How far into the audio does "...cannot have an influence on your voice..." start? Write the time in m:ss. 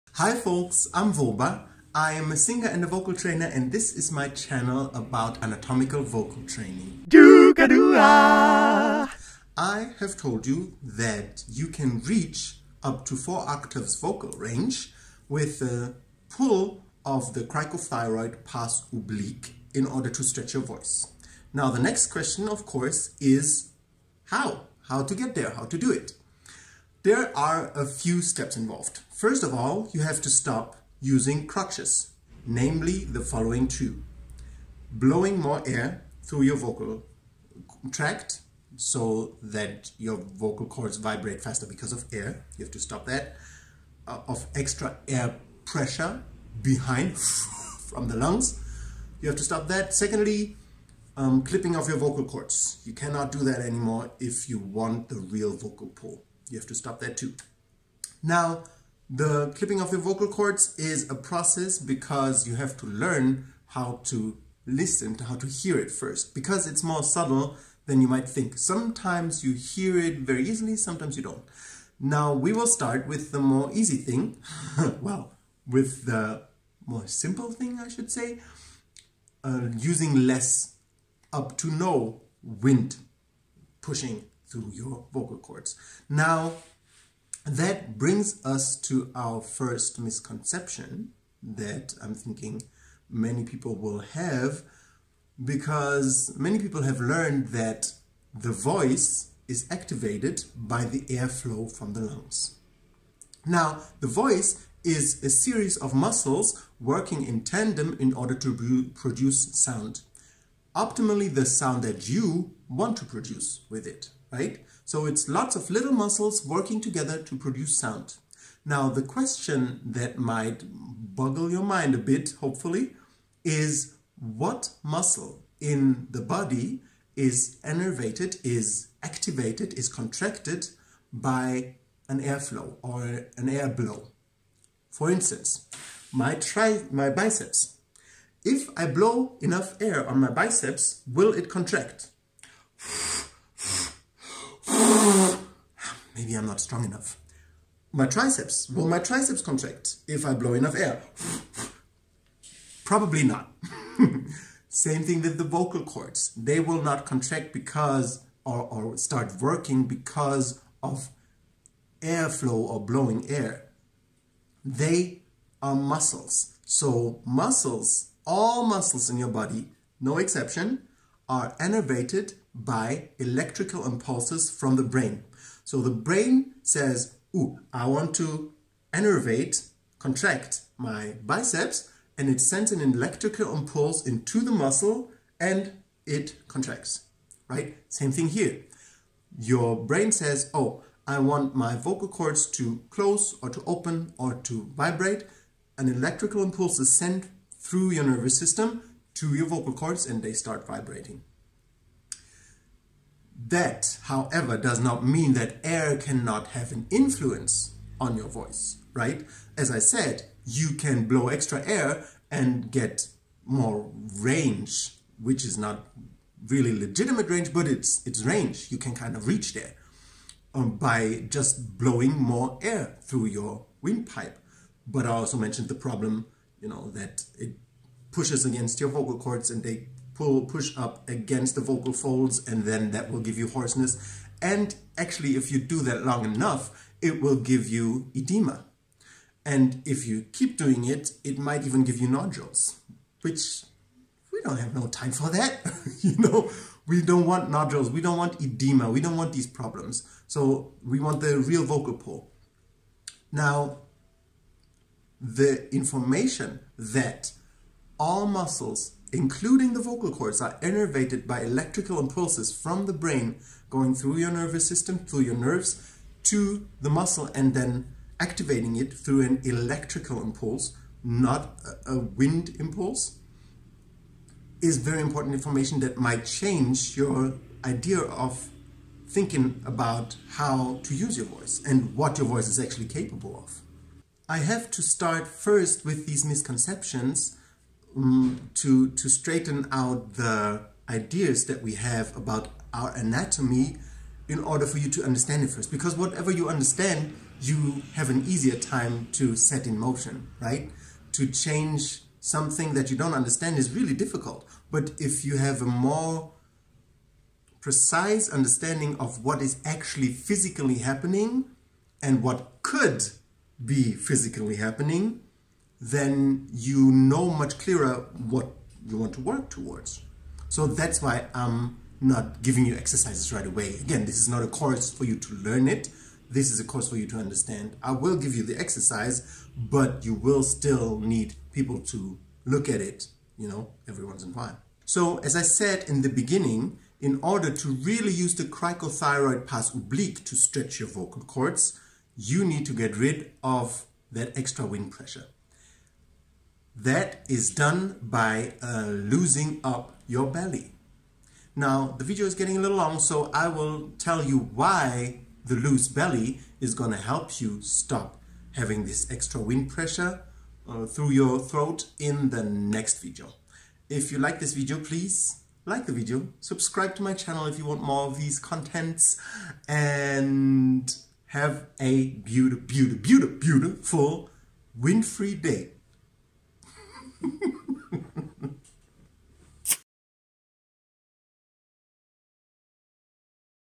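3:25.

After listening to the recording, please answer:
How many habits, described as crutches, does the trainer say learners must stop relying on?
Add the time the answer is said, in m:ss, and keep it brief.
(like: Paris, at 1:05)
2, at 0:33.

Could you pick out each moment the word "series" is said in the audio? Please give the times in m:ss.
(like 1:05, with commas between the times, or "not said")
1:45.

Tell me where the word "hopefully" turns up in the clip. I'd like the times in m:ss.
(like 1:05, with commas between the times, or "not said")
2:02.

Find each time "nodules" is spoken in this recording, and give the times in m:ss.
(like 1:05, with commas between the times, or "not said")
4:02, 4:07.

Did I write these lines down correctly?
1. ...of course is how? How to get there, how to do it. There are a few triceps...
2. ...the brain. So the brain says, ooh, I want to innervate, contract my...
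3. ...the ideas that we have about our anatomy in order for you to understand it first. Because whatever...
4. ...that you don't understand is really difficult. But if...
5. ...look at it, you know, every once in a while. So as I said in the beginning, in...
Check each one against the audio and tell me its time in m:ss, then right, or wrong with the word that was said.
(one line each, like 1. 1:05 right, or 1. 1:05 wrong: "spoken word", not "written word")
1. 0:22 wrong: "steps", not "triceps"
2. 2:54 right
3. 4:50 right
4. 5:02 right
5. 5:32 right.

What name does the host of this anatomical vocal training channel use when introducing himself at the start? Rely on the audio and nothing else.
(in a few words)
Voba.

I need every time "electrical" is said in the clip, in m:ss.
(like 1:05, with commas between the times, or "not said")
2:53, 3:02, 3:15, 4:21, 4:29.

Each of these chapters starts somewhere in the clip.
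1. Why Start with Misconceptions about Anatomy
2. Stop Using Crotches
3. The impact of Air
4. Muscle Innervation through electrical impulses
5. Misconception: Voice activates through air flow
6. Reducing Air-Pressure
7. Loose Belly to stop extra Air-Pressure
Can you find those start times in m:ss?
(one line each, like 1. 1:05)
1. 4:44
2. 0:21
3. 3:23
4. 4:15
5. 1:27
6. 1:11
7. 5:34.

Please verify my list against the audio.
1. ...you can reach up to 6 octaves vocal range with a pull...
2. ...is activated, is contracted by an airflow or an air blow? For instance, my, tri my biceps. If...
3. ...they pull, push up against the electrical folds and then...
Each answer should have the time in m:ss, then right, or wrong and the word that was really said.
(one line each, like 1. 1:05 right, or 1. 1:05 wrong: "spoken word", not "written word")
1. 0:11 wrong: "4", not "6"
2. 2:08 right
3. 3:49 wrong: "vocal", not "electrical".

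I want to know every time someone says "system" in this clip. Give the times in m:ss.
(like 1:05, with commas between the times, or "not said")
3:18, 4:24.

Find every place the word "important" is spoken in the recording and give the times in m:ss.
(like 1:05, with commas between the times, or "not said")
4:35.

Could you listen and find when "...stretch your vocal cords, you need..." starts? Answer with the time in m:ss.
5:40.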